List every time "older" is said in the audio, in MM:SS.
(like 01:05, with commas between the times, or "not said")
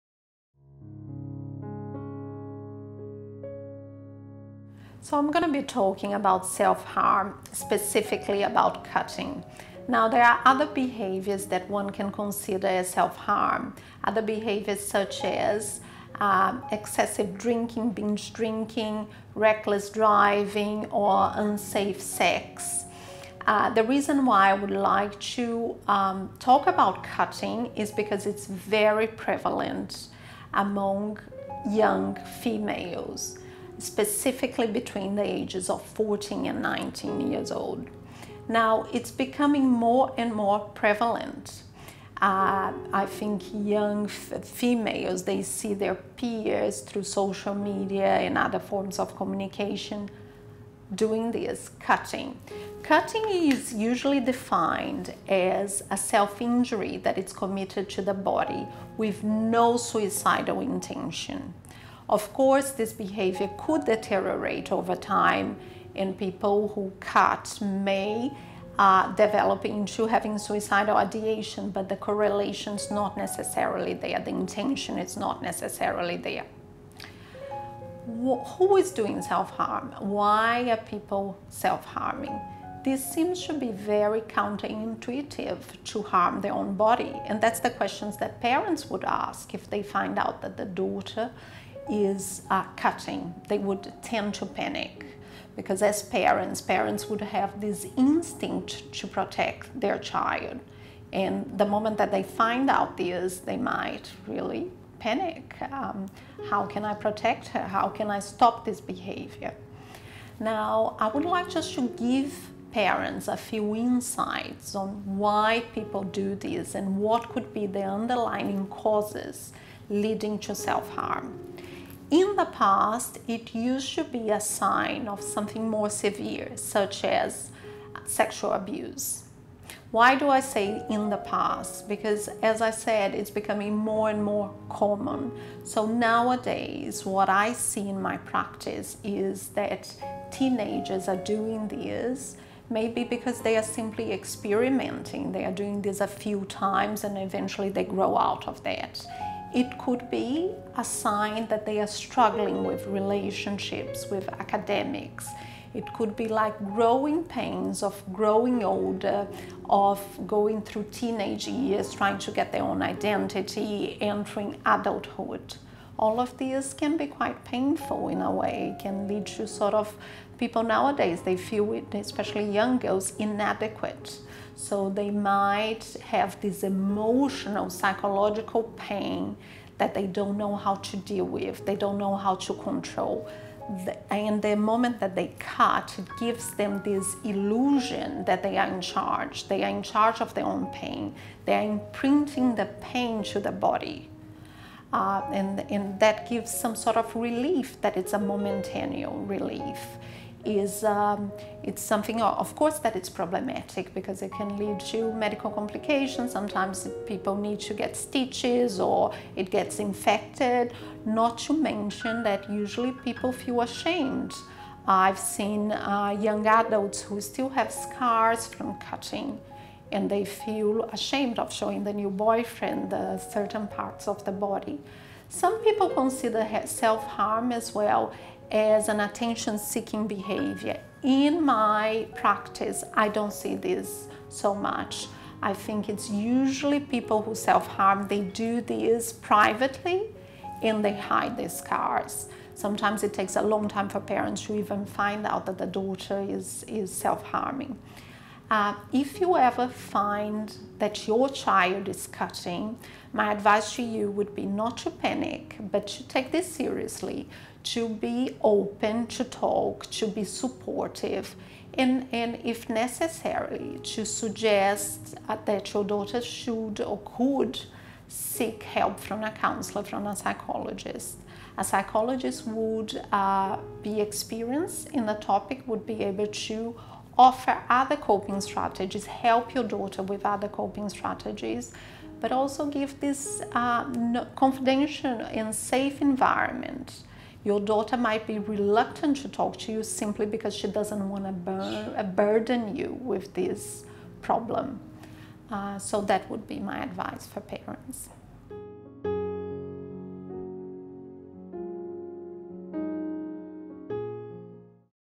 02:38.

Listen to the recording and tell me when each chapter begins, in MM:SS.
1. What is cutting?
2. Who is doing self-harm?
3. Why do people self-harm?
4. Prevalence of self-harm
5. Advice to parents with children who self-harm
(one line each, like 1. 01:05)
1. 00:54
2. 01:19
3. 01:50
4. 00:24
5. 04:15.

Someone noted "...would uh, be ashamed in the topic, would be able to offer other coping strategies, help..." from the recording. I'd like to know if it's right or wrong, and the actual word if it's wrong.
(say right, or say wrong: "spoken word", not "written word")
wrong: "experienced", not "ashamed".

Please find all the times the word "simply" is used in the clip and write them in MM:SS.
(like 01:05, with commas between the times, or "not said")
02:23, 04:49.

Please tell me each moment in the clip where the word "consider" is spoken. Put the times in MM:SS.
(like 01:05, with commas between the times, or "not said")
00:12, 03:45.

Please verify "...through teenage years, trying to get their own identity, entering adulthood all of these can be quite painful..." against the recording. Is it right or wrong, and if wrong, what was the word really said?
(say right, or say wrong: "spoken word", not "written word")
right.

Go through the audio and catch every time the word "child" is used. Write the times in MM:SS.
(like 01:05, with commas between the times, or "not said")
01:39, 04:11.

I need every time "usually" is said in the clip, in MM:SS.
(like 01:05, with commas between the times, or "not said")
00:53, 03:32, 03:56.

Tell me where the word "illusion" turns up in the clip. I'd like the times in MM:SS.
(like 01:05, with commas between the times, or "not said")
03:07.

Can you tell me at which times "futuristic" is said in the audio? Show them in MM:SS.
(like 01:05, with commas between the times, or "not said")
not said.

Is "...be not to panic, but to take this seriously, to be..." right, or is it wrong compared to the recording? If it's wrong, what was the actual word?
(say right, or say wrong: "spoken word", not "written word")
right.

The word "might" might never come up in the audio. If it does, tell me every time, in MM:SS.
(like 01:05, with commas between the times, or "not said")
01:43, 02:55, 04:47.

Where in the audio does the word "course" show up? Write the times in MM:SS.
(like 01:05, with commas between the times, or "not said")
01:02, 03:22.